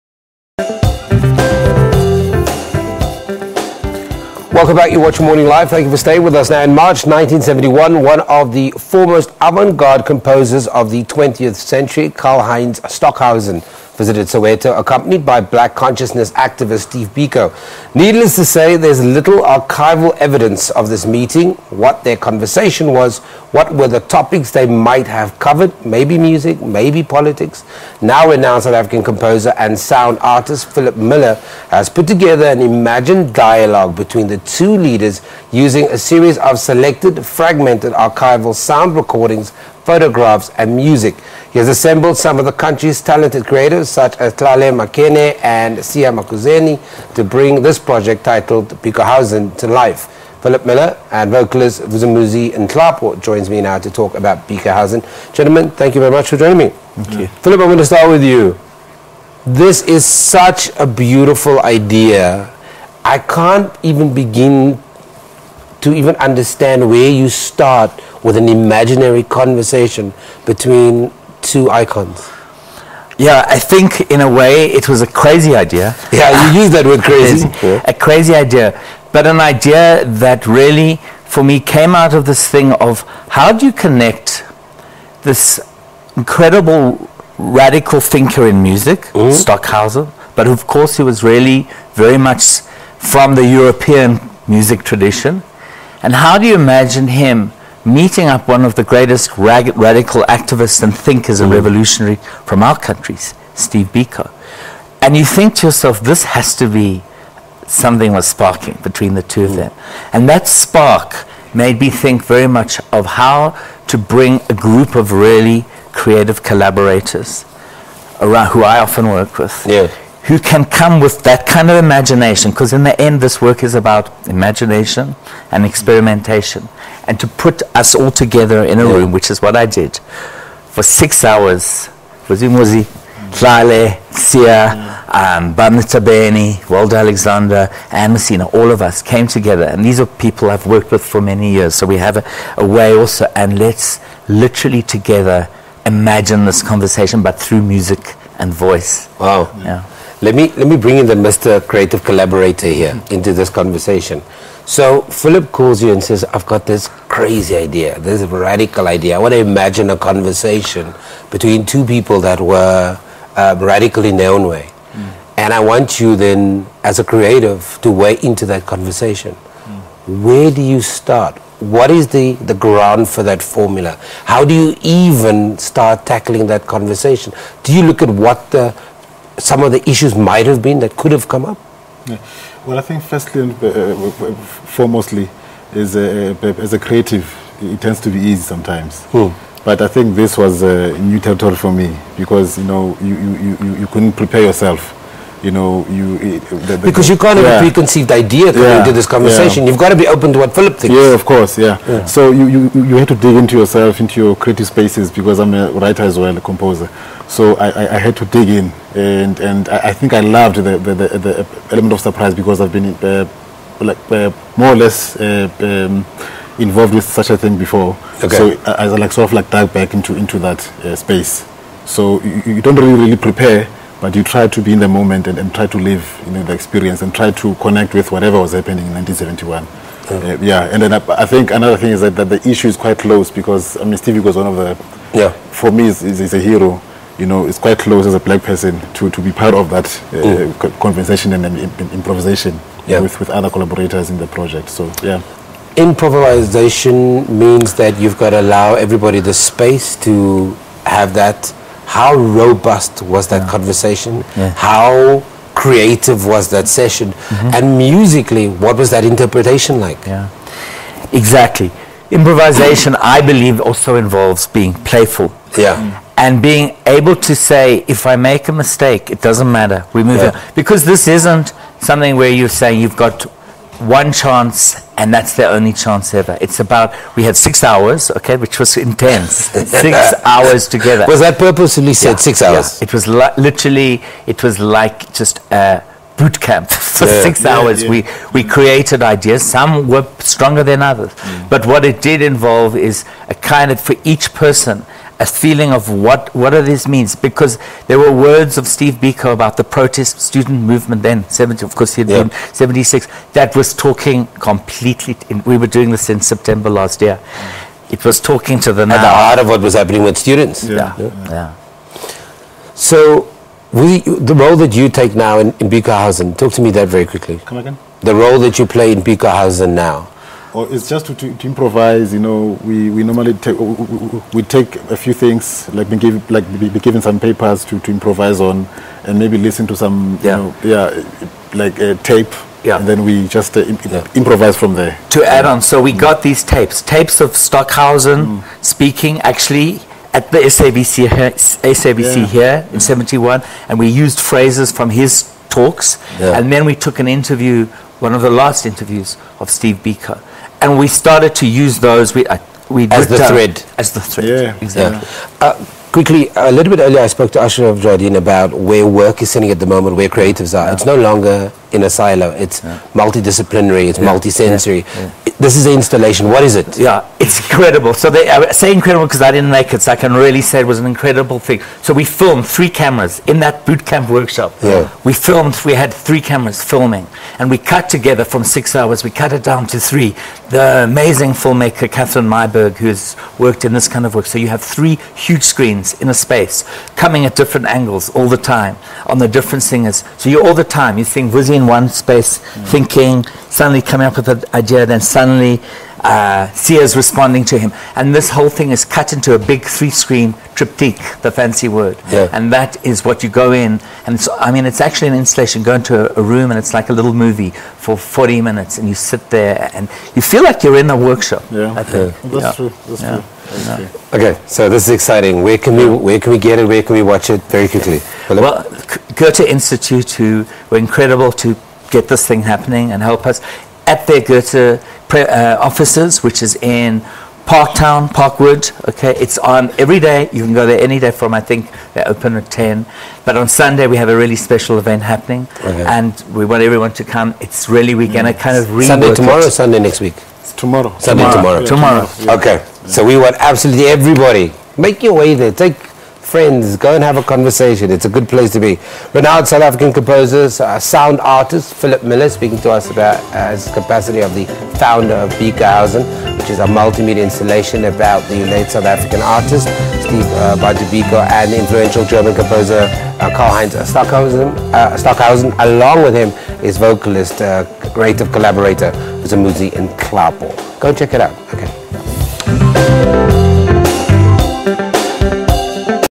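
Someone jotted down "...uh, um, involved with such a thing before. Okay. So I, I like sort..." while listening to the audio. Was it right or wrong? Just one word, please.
right.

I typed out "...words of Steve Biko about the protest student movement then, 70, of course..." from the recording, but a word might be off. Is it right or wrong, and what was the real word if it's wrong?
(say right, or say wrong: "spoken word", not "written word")
right.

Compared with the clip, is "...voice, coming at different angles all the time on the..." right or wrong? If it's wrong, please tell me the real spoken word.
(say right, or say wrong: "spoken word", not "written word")
wrong: "space", not "voice".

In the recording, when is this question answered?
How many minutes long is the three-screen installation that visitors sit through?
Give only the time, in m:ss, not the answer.
6:47.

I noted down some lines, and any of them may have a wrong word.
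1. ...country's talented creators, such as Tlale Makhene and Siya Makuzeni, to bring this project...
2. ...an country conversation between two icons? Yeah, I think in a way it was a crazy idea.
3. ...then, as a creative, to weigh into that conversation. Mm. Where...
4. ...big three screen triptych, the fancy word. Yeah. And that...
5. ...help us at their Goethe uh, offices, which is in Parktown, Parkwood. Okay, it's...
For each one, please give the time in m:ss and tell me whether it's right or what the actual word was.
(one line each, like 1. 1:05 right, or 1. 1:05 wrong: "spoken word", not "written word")
1. 0:42 right
2. 1:08 wrong: "imaginary", not "country"
3. 2:46 right
4. 6:39 right
5. 7:03 right.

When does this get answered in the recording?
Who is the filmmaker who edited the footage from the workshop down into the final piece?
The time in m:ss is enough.
6:21.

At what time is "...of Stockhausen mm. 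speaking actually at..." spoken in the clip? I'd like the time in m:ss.
5:37.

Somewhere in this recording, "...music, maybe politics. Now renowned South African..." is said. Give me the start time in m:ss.
0:26.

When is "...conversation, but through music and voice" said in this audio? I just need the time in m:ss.
2:26.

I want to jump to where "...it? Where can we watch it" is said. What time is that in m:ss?
6:56.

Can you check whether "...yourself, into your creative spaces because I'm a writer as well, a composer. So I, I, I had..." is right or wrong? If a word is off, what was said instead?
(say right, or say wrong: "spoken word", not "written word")
right.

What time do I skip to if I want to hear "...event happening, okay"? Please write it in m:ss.
7:14.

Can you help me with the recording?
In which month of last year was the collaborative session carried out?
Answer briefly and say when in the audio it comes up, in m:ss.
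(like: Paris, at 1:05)
September, at 5:06.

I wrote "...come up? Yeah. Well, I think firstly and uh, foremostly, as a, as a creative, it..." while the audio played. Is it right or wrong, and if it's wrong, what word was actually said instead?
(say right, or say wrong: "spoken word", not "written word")
right.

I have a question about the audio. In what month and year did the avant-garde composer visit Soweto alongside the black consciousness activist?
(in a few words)
March 1971.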